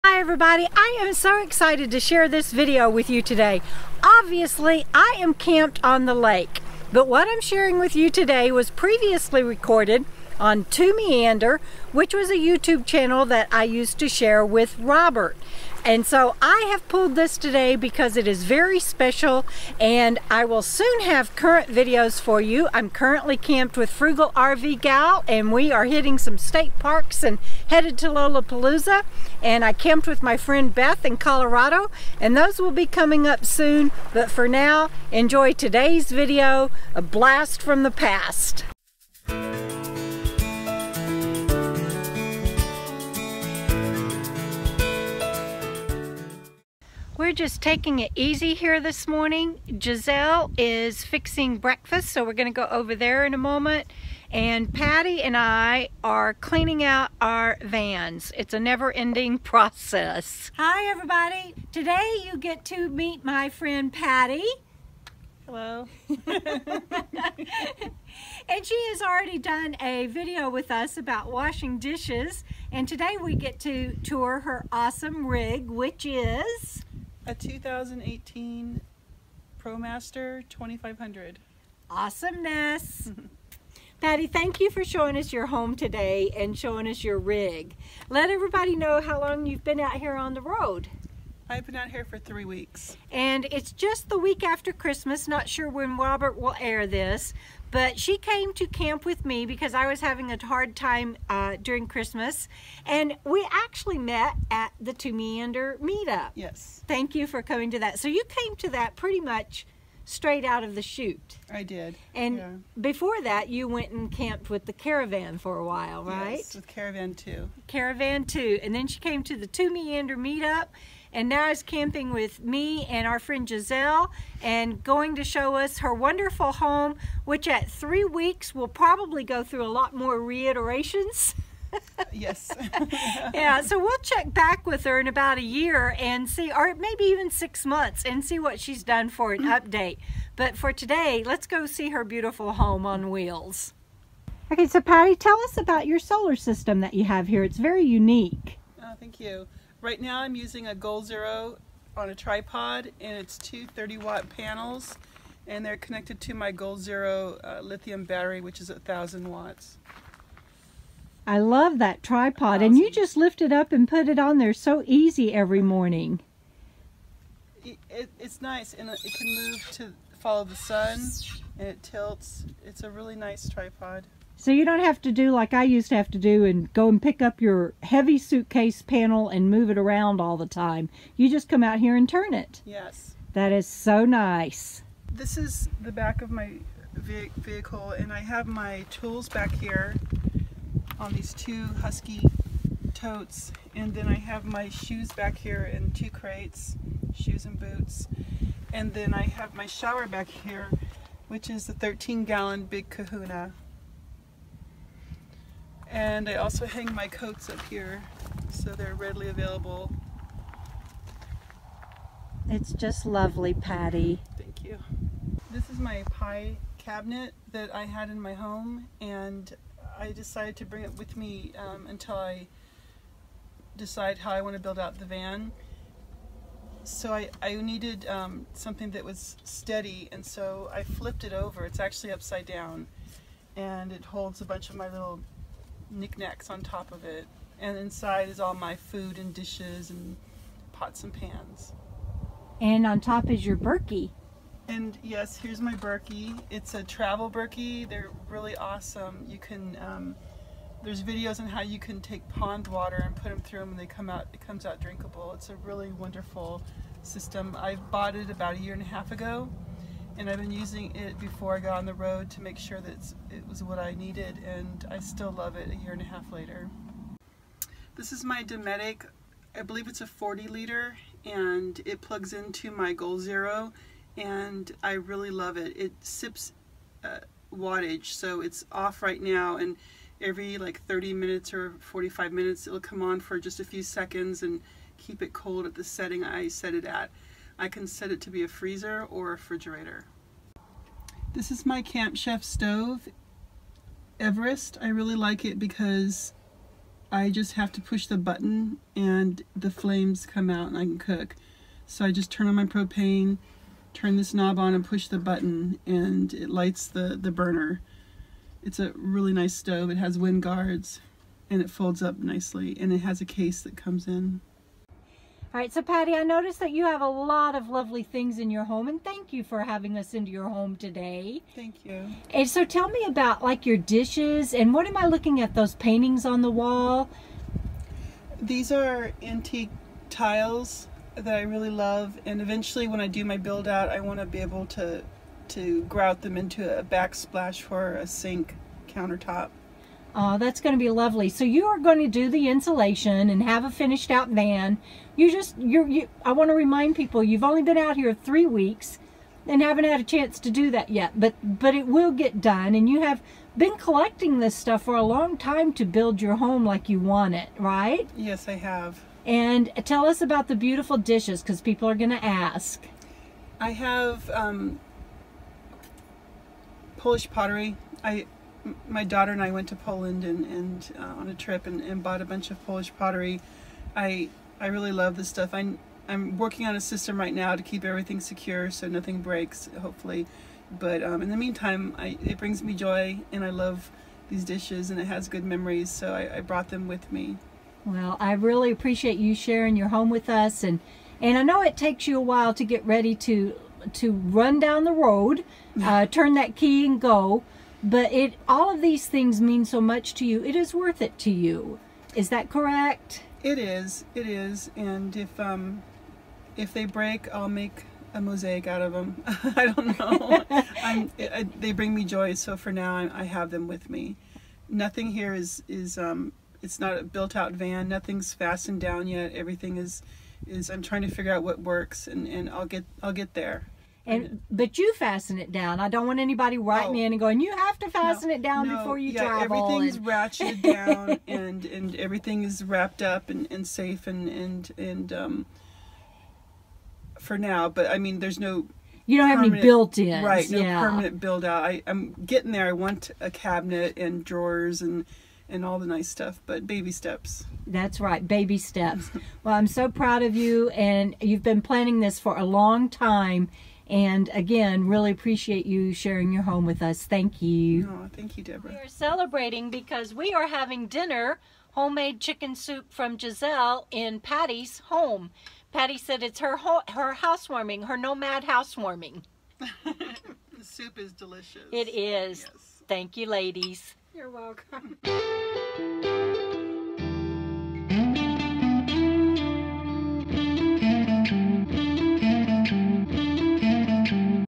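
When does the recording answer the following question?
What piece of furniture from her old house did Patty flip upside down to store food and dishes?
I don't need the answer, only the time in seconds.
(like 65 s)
216 s.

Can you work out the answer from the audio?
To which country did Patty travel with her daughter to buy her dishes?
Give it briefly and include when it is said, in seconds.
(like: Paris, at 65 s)
Poland, at 369 s.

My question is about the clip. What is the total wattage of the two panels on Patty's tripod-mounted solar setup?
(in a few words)
2 x 30 watts.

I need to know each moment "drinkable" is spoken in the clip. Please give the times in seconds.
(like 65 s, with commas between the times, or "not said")
254 s.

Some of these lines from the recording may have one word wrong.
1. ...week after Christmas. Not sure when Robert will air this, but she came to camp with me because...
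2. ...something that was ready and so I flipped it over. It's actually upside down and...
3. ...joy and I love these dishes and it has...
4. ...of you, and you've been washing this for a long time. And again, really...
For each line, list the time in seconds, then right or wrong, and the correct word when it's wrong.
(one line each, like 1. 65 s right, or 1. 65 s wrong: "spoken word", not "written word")
1. 94 s right
2. 228 s wrong: "steady", not "ready"
3. 382 s right
4. 450 s wrong: "planning", not "washing".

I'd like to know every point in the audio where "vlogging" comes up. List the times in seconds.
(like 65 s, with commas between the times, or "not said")
not said.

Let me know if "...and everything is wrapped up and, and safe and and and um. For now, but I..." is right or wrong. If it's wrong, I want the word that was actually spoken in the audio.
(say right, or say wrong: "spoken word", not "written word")
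right.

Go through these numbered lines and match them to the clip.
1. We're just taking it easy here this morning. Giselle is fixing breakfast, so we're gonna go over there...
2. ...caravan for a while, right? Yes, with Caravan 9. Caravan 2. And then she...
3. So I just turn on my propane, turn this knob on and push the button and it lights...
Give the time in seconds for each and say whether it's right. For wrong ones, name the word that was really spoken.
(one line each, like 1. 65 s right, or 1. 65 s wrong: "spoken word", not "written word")
1. 47 s right
2. 114 s wrong: "2", not "9"
3. 301 s right.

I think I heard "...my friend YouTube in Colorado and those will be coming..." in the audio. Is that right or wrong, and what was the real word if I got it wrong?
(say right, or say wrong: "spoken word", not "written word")
wrong: "Beth", not "YouTube".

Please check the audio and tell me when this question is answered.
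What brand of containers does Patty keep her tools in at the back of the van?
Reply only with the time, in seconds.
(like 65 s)
191 s.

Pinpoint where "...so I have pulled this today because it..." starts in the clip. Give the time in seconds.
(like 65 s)
16 s.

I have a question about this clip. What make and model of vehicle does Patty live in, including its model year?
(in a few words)
2018 ProMaster 2500.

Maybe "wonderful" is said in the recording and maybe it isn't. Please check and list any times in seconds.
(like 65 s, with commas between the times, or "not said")
125 s, 255 s.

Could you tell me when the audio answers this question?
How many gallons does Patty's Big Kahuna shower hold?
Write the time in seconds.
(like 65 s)
201 s.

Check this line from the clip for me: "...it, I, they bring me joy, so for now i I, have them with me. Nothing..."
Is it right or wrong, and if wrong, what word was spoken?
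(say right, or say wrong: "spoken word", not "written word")
right.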